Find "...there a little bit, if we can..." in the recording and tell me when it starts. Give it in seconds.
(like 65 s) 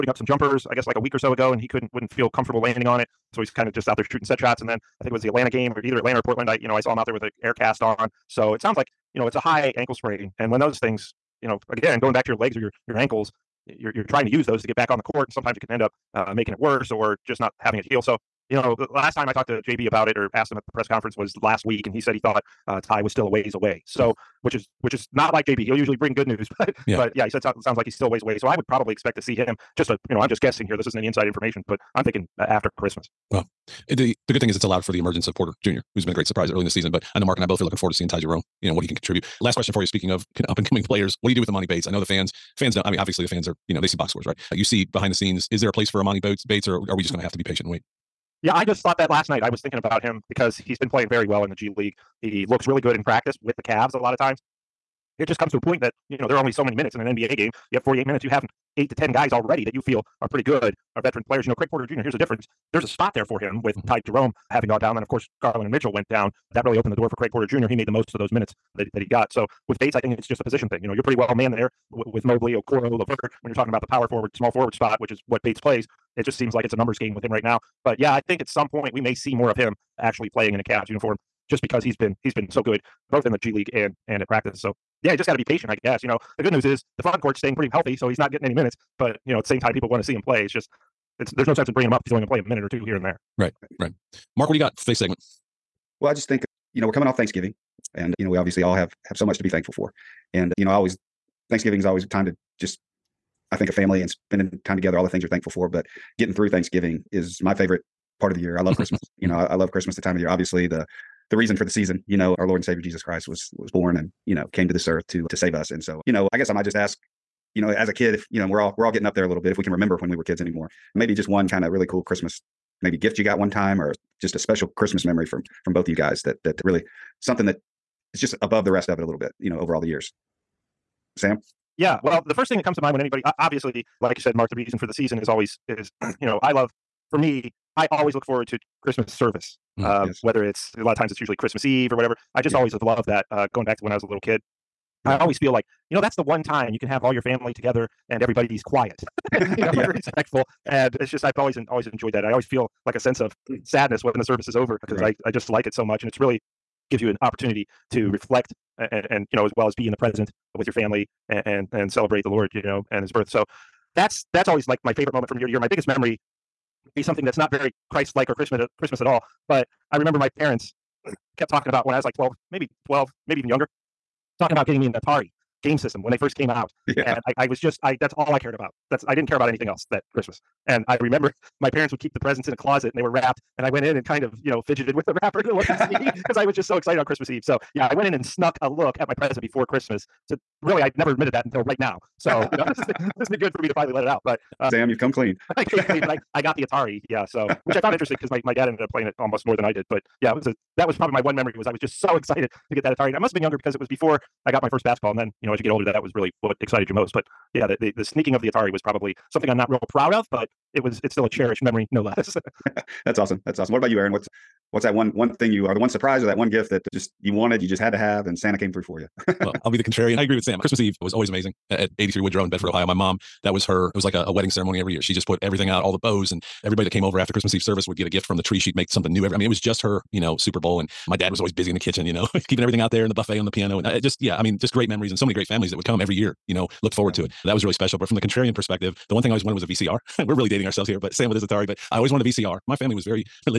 119 s.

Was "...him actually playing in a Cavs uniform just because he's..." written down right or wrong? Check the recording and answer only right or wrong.
right.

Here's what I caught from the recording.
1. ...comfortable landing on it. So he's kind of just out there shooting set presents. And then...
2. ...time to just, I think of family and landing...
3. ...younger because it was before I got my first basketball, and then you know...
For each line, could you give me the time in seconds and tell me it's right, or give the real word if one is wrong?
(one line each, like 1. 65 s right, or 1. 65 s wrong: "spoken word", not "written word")
1. 2 s wrong: "shots", not "presents"
2. 102 s wrong: "spending", not "landing"
3. 203 s right.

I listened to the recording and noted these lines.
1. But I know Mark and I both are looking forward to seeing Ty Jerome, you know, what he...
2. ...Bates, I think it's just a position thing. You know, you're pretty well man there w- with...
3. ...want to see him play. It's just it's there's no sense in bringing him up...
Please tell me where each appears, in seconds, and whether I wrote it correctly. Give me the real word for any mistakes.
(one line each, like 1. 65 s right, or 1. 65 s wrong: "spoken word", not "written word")
1. 36 s right
2. 69 s right
3. 89 s right.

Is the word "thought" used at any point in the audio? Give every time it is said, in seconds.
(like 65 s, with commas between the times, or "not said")
22 s, 48 s.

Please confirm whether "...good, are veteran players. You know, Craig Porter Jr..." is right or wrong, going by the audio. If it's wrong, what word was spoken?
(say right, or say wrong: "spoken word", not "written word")
right.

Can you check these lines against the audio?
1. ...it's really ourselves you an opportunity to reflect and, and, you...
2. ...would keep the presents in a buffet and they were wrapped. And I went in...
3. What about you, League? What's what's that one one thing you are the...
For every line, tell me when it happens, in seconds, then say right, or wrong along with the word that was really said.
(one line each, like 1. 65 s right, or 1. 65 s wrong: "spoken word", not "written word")
1. 156 s wrong: "gives", not "ourselves"
2. 181 s wrong: "closet", not "buffet"
3. 213 s wrong: "Aaron", not "League".